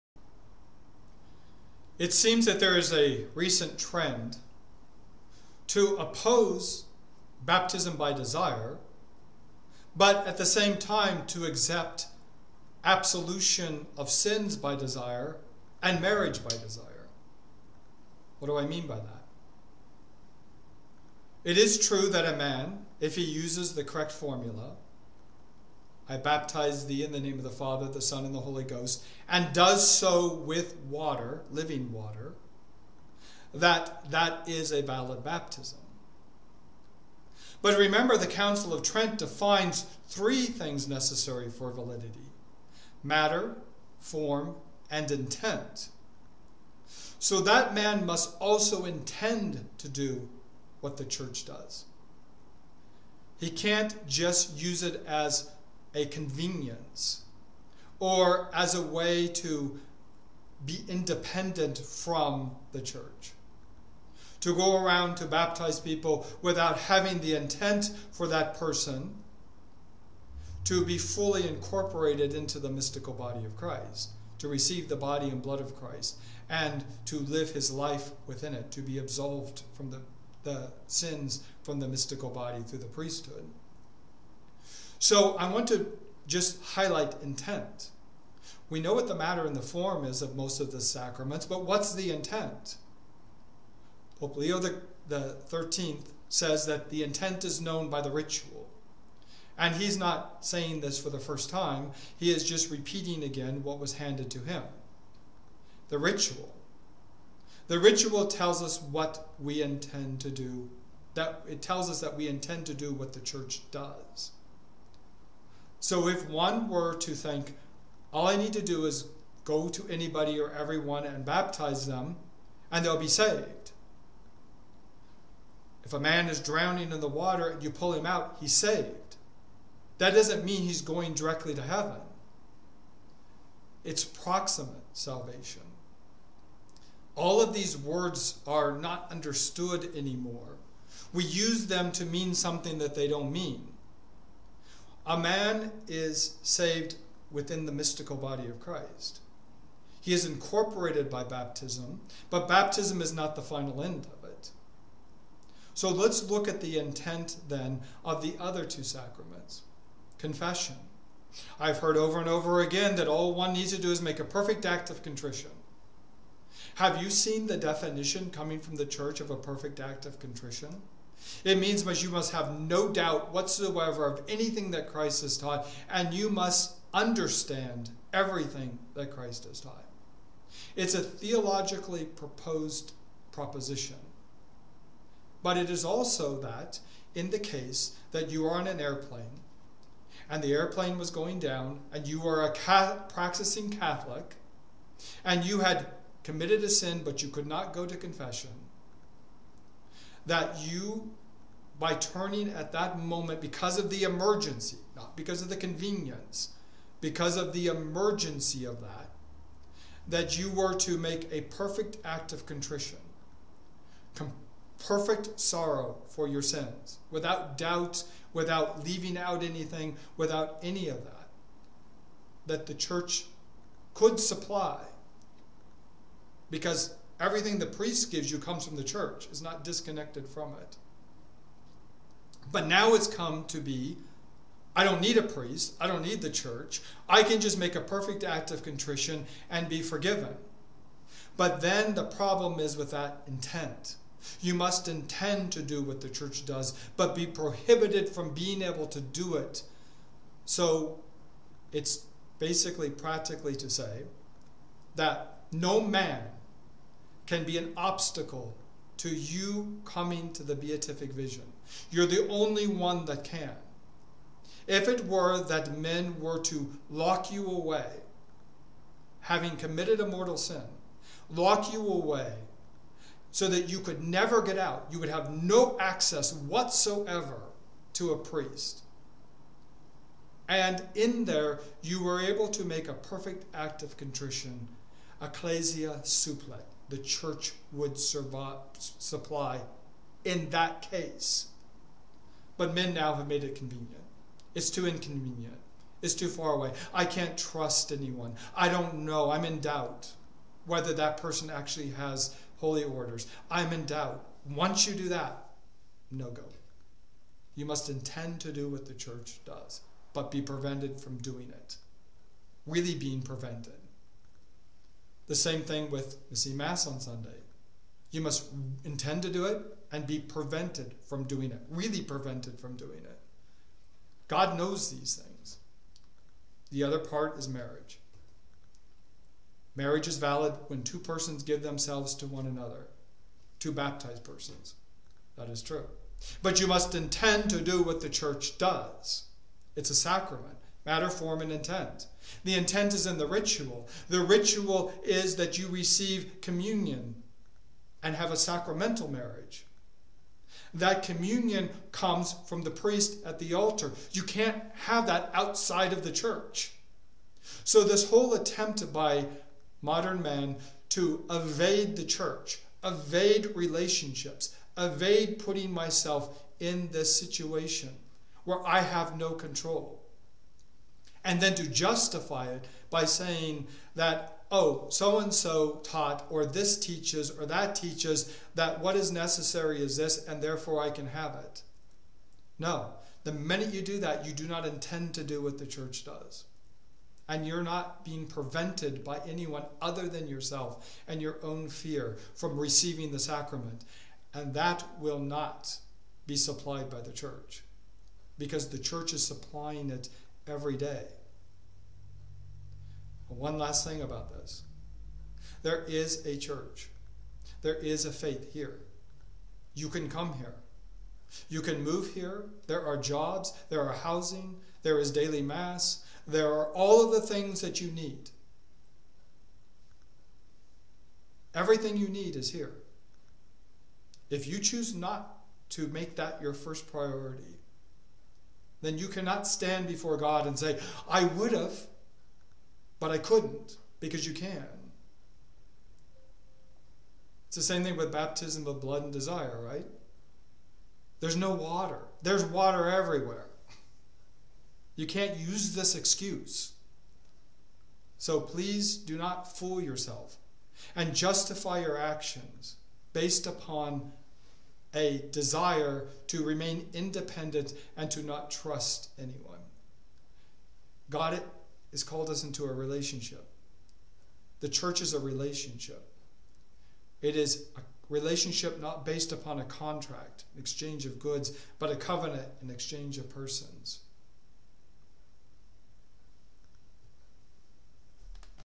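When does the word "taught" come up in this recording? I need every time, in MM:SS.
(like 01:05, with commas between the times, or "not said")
02:55, 02:59, 06:15.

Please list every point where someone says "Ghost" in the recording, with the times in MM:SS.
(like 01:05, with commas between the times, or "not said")
00:28.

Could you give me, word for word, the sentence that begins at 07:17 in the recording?
It's the same thing with baptism of blood and desire, right?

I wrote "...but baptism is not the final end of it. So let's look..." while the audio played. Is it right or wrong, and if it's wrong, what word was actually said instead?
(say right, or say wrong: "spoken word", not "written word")
right.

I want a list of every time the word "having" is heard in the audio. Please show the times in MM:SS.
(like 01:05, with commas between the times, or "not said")
01:06, 04:29.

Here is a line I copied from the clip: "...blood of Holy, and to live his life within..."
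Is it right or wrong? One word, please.
wrong.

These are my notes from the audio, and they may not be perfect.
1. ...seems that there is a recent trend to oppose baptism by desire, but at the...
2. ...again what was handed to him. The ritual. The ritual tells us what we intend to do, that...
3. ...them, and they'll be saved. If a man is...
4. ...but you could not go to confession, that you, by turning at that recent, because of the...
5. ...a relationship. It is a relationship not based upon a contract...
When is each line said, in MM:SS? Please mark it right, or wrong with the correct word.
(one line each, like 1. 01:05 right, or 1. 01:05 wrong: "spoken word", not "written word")
1. 00:02 right
2. 01:43 right
3. 02:01 right
4. 03:17 wrong: "moment", not "recent"
5. 07:45 right.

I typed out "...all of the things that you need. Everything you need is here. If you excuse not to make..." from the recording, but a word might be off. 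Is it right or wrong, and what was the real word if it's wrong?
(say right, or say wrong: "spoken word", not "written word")
wrong: "choose", not "excuse".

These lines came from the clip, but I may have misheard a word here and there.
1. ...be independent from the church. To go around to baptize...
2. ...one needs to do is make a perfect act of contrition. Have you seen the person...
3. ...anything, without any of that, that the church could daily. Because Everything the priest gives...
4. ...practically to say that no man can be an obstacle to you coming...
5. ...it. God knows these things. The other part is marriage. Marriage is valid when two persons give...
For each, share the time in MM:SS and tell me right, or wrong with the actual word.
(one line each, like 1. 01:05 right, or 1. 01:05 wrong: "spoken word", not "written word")
1. 01:00 right
2. 02:43 wrong: "definition", not "person"
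3. 03:39 wrong: "supply", not "daily"
4. 04:12 right
5. 05:23 right.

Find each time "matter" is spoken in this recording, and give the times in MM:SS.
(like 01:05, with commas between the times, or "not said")
00:43, 01:29, 05:40.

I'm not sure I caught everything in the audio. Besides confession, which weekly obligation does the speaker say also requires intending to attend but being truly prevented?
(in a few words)
Mass on Sunday.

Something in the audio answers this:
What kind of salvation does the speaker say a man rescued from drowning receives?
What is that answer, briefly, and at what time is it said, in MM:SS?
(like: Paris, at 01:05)
Proximate salvation, at 02:14.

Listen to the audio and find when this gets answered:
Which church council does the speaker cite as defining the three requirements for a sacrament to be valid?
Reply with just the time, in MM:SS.
00:38.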